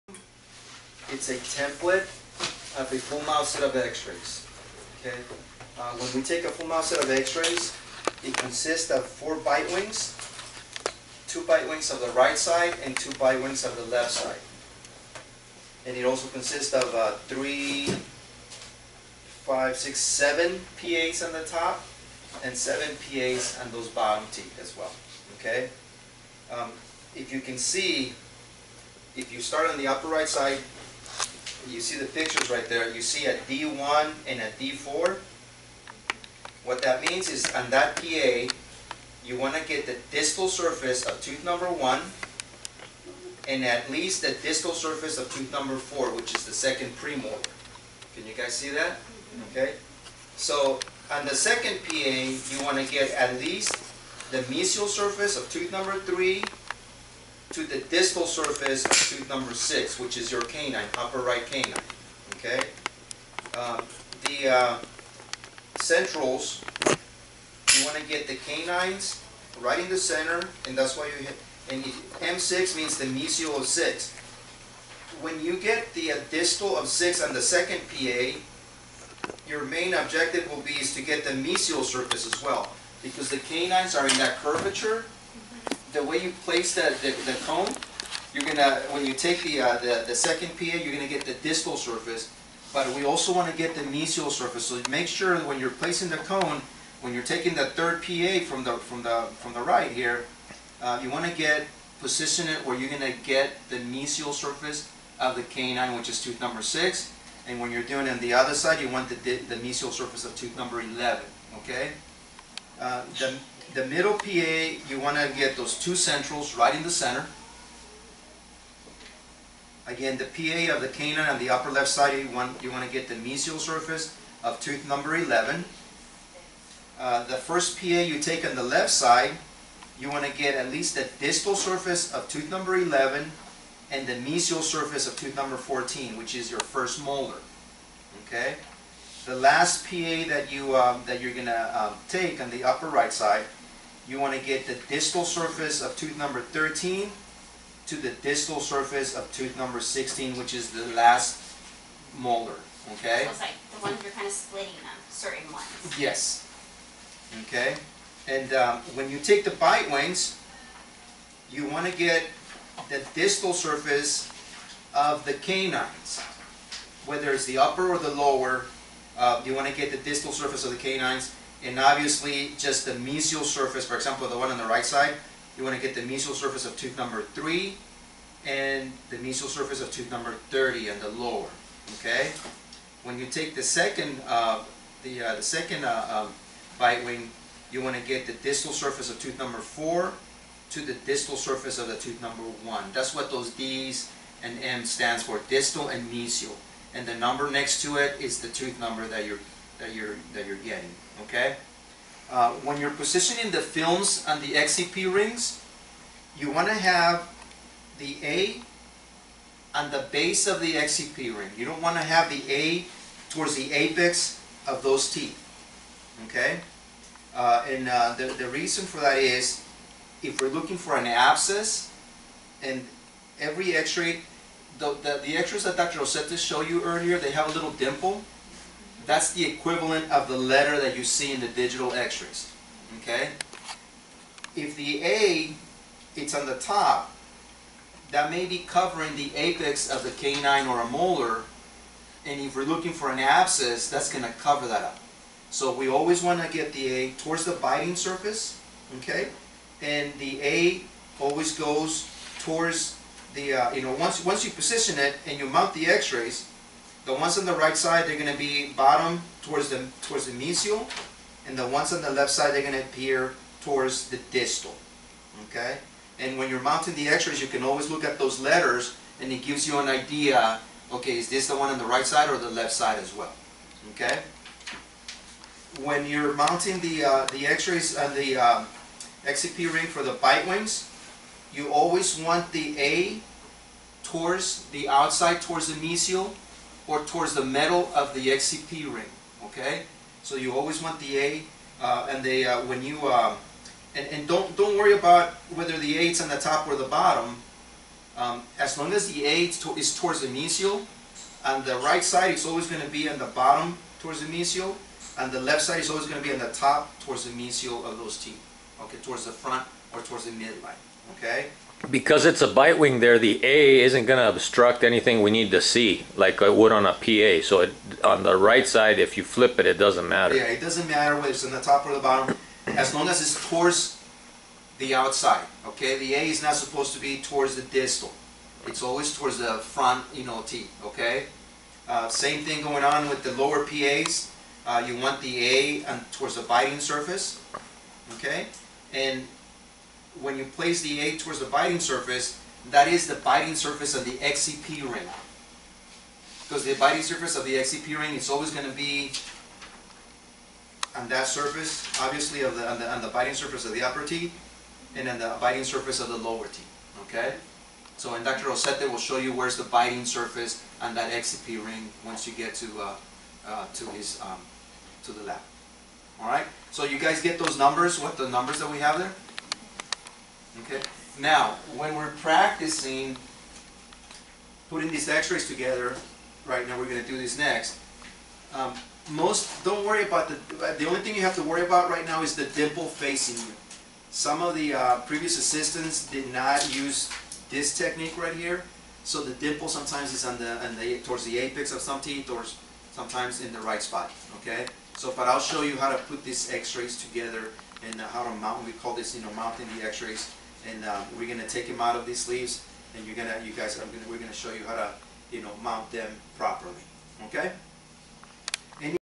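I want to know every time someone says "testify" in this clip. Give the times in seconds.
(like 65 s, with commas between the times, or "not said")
not said.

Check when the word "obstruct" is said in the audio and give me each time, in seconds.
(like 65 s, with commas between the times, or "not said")
314 s.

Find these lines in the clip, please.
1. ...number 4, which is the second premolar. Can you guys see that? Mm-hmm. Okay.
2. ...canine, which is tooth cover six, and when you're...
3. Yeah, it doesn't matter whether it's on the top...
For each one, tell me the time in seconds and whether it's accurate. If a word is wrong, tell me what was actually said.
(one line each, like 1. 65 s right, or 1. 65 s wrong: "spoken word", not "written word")
1. 45 s right
2. 105 s wrong: "number", not "cover"
3. 320 s right.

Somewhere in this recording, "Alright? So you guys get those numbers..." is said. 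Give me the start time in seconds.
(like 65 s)
366 s.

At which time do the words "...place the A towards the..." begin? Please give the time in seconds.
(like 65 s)
340 s.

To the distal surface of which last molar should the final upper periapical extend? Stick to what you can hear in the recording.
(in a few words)
Tooth number 16.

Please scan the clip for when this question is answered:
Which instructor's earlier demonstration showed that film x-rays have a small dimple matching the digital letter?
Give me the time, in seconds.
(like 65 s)
225 s.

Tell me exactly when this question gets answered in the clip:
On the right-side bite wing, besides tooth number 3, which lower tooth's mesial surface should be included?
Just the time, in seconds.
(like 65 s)
179 s.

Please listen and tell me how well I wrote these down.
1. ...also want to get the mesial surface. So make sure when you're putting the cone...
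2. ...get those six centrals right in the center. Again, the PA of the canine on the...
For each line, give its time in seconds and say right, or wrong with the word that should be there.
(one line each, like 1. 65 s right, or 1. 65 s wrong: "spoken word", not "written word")
1. 93 s wrong: "placing", not "putting"
2. 115 s wrong: "two", not "six".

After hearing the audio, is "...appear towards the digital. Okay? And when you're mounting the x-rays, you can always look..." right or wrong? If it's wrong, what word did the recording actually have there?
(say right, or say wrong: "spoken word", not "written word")
wrong: "distal", not "digital".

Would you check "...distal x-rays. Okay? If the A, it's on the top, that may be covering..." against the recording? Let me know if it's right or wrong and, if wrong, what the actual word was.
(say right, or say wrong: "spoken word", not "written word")
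wrong: "digital", not "distal".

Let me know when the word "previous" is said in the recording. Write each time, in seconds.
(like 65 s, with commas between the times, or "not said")
385 s.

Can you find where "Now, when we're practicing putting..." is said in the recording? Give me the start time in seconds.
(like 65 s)
371 s.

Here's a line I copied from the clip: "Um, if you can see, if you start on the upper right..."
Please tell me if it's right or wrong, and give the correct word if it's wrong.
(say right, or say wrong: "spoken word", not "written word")
right.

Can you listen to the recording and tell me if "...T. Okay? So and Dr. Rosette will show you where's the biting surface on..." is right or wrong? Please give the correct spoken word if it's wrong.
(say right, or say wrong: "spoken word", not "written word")
right.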